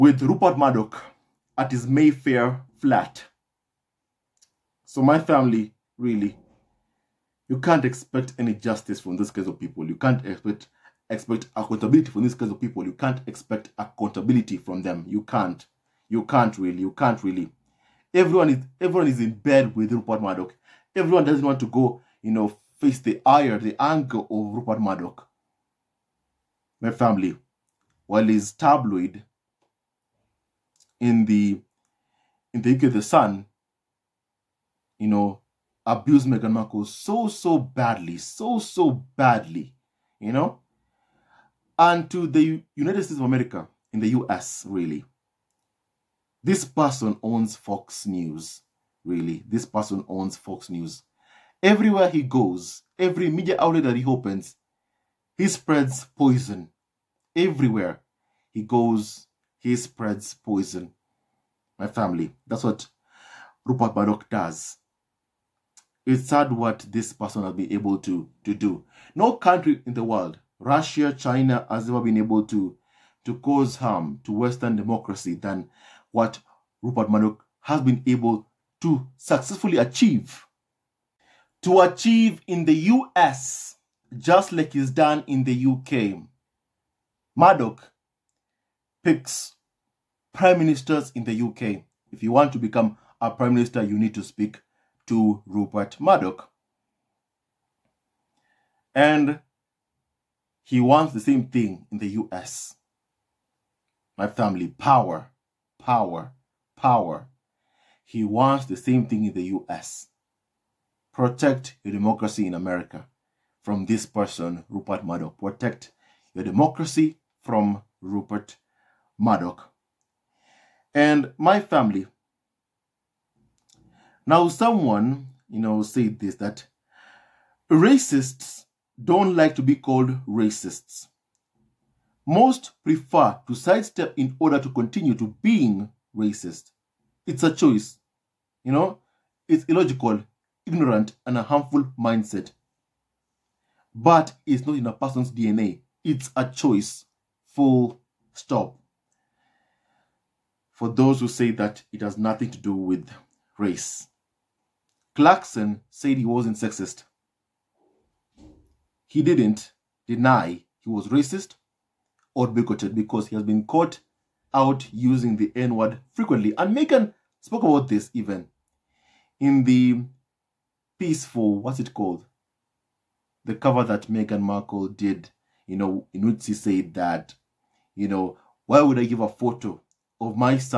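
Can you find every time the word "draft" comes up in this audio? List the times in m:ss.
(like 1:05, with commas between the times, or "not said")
not said.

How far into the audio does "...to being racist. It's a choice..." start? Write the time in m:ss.
2:15.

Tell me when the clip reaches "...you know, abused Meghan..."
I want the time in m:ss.
0:34.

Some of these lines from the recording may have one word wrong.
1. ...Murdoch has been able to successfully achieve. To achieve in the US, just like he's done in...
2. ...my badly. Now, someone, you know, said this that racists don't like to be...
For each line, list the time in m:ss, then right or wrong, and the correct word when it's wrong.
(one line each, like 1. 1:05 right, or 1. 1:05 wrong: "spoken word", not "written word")
1. 1:17 right
2. 2:01 wrong: "family", not "badly".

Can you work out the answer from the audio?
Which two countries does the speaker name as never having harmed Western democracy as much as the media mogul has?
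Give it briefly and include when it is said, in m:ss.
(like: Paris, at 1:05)
Russia, China, at 1:10.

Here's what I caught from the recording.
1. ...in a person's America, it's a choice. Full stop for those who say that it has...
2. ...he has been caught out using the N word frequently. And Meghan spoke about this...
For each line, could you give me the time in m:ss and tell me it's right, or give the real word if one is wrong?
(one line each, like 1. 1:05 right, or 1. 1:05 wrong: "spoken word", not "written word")
1. 2:24 wrong: "DNA", not "America"
2. 2:43 right.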